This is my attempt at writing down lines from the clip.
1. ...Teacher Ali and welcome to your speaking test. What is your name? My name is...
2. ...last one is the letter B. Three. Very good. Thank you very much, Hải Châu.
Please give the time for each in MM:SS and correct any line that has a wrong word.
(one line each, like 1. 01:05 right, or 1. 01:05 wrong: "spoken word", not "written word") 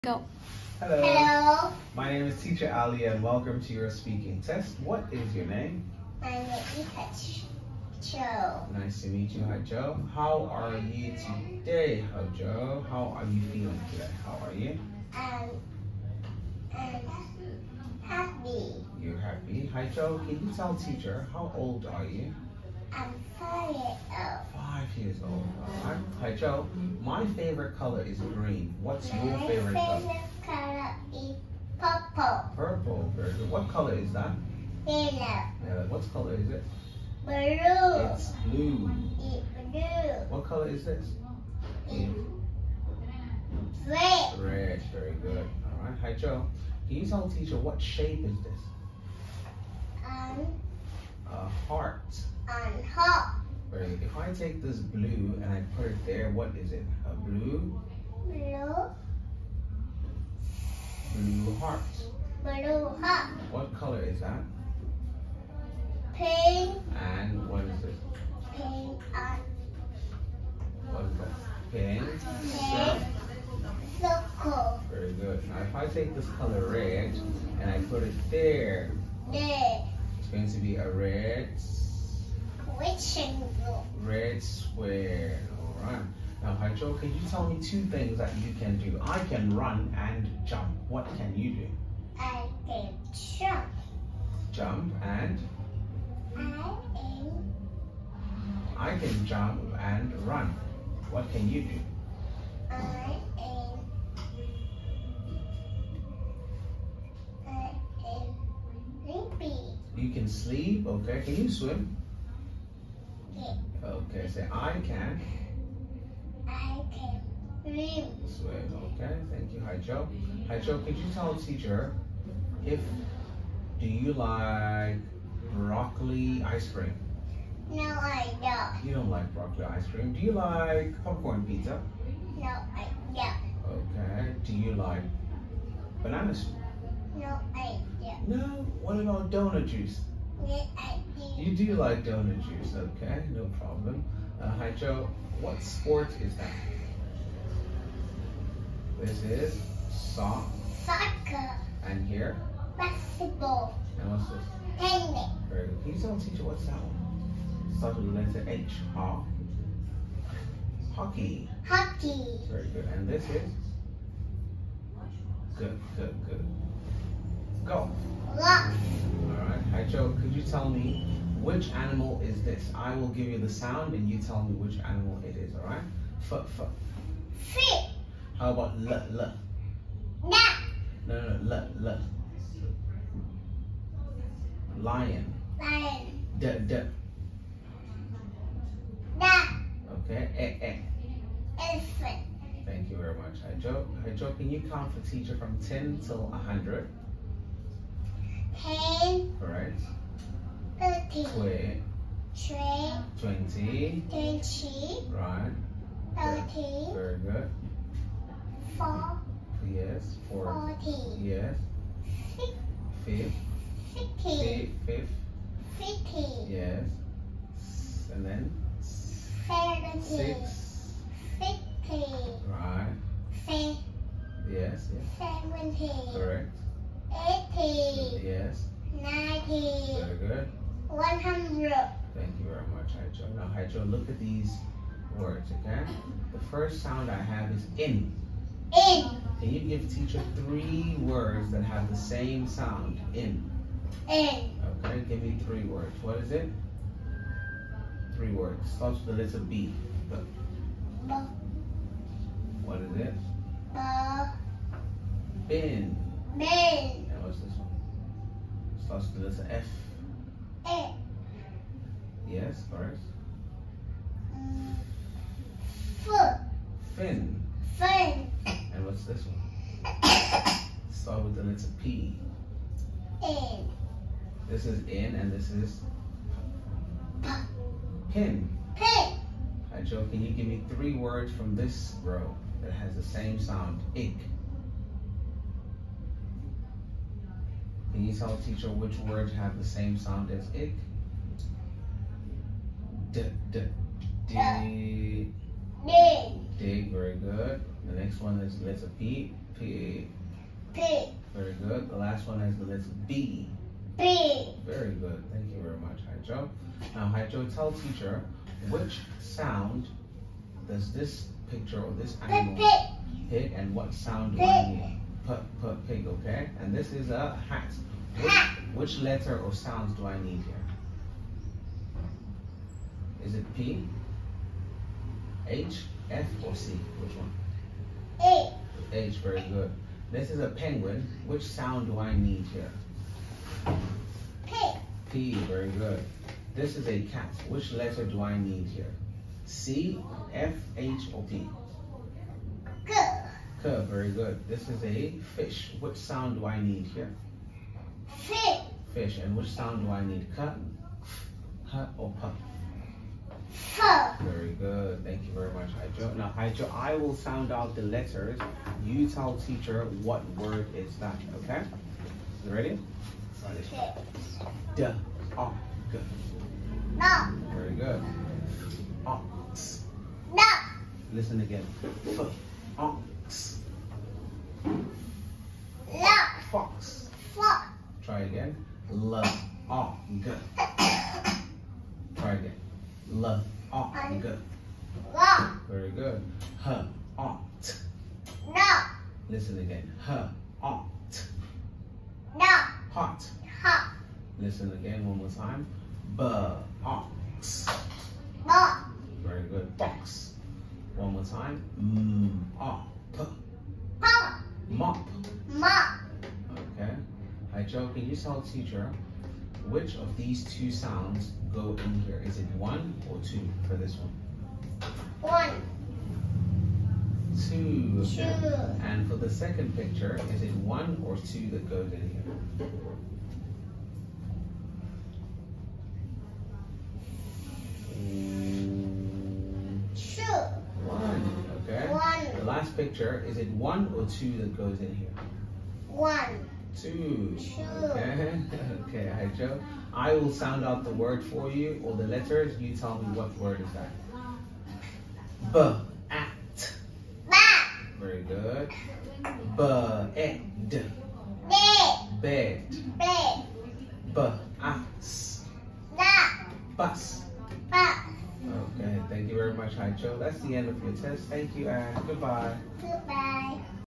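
1. 00:02 right
2. 05:01 right.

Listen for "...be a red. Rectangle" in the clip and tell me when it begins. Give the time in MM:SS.
01:20.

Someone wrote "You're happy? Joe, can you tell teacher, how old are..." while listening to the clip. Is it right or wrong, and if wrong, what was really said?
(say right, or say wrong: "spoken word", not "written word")
right.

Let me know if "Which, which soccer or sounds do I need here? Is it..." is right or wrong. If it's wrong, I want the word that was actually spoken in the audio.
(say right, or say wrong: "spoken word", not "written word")
wrong: "letter", not "soccer".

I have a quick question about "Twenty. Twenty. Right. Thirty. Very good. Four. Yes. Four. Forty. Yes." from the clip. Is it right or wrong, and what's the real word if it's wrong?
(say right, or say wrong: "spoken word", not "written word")
right.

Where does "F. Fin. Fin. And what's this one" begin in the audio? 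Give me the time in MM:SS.
04:26.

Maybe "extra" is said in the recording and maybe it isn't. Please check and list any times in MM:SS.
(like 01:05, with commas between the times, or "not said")
not said.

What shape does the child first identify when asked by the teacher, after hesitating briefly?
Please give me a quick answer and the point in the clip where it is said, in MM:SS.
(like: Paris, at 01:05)
A heart, at 00:51.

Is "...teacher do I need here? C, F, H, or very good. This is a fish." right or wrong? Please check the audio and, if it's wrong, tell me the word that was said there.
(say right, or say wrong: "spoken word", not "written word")
wrong: "letter", not "teacher".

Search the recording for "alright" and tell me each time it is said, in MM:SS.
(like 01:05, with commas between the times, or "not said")
01:25, 02:49, 02:55, 03:19.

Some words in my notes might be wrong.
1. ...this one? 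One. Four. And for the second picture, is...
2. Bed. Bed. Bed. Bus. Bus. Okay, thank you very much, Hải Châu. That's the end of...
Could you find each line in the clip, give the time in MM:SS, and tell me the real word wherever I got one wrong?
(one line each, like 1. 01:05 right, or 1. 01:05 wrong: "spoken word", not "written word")
1. 06:53 wrong: "Two", not "Four"
2. 07:29 right.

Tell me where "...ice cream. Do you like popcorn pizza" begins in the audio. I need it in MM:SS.
02:09.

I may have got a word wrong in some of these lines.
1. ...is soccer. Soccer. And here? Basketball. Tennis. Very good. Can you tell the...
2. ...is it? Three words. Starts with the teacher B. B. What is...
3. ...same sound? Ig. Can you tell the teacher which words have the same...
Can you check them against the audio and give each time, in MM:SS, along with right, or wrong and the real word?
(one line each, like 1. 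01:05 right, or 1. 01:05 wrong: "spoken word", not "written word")
1. 02:29 right
2. 04:06 wrong: "letter", not "teacher"
3. 04:43 right.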